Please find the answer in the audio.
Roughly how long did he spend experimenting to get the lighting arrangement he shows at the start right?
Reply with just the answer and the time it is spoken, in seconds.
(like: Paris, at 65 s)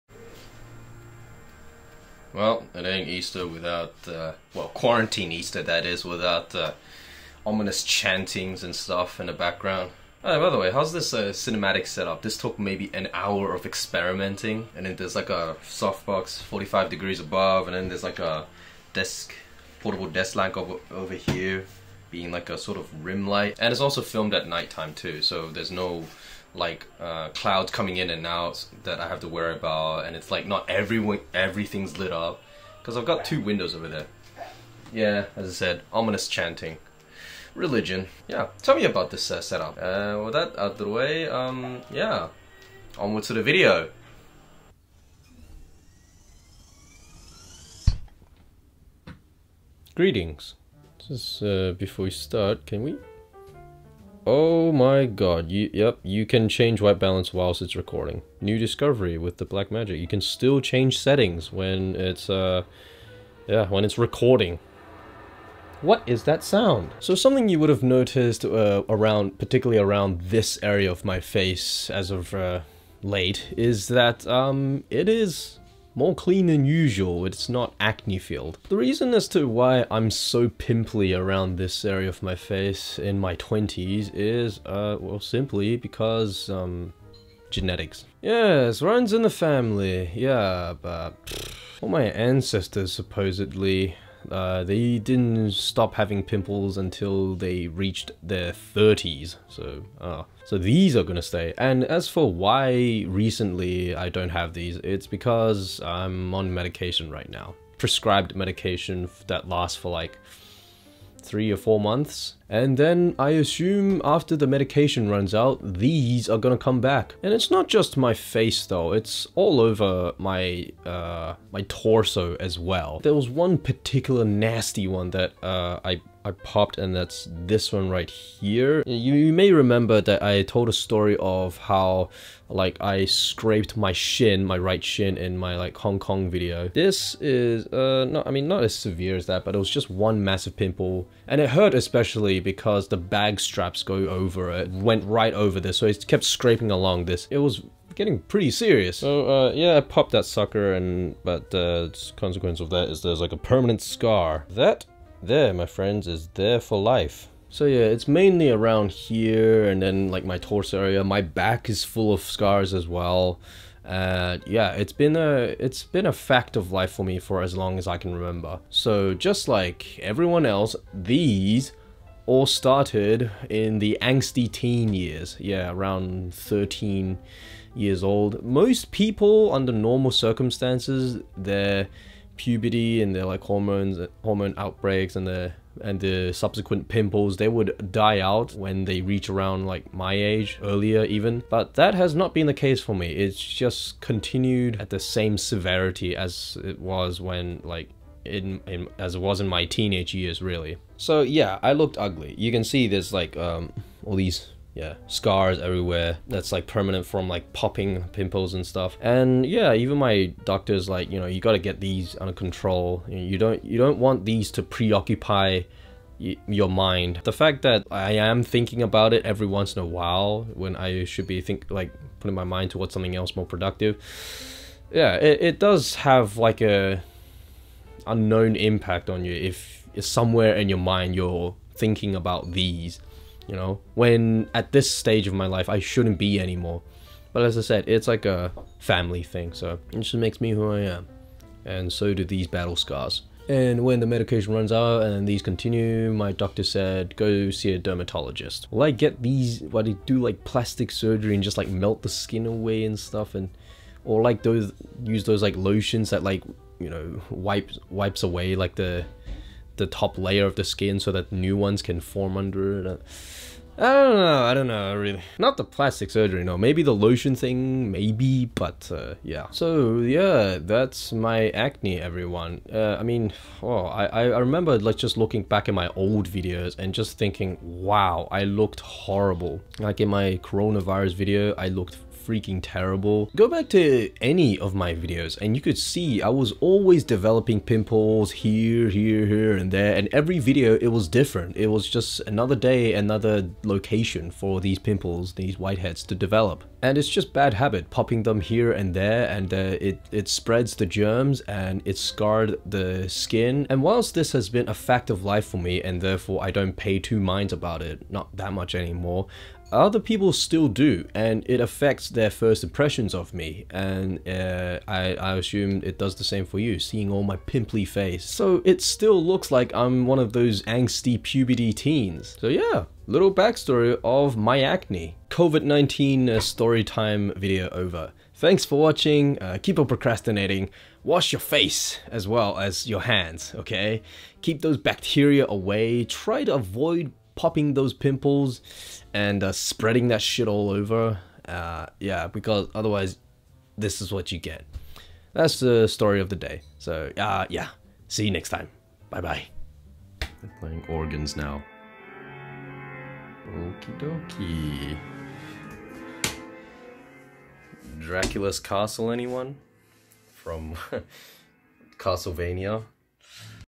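an hour, at 12 s.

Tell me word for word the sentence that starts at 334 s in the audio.
Keep those bacteria away, try to avoid popping those pimples and uh, spreading that shit all over.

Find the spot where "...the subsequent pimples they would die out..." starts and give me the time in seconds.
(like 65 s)
186 s.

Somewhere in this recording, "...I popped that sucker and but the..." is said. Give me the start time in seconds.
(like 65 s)
149 s.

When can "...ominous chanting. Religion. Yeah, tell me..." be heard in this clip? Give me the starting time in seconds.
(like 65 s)
35 s.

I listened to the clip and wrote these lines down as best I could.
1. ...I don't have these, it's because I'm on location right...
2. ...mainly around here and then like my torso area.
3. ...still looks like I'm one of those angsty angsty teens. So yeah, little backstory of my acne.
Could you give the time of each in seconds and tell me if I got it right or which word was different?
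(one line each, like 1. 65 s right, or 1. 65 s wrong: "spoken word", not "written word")
1. 103 s wrong: "medication", not "location"
2. 158 s right
3. 318 s wrong: "puberty", not "angsty".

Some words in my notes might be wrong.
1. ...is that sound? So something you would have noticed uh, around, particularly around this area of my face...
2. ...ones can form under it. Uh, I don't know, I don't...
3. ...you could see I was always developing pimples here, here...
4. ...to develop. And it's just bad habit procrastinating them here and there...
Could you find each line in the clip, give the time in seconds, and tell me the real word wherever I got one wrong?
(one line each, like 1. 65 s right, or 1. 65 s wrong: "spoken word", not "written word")
1. 66 s right
2. 261 s right
3. 285 s right
4. 296 s wrong: "popping", not "procrastinating".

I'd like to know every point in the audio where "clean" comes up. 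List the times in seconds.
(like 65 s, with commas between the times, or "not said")
76 s.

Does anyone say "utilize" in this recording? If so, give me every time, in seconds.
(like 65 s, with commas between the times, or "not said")
not said.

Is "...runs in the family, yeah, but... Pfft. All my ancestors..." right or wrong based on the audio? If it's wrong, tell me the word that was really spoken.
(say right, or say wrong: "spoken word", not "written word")
right.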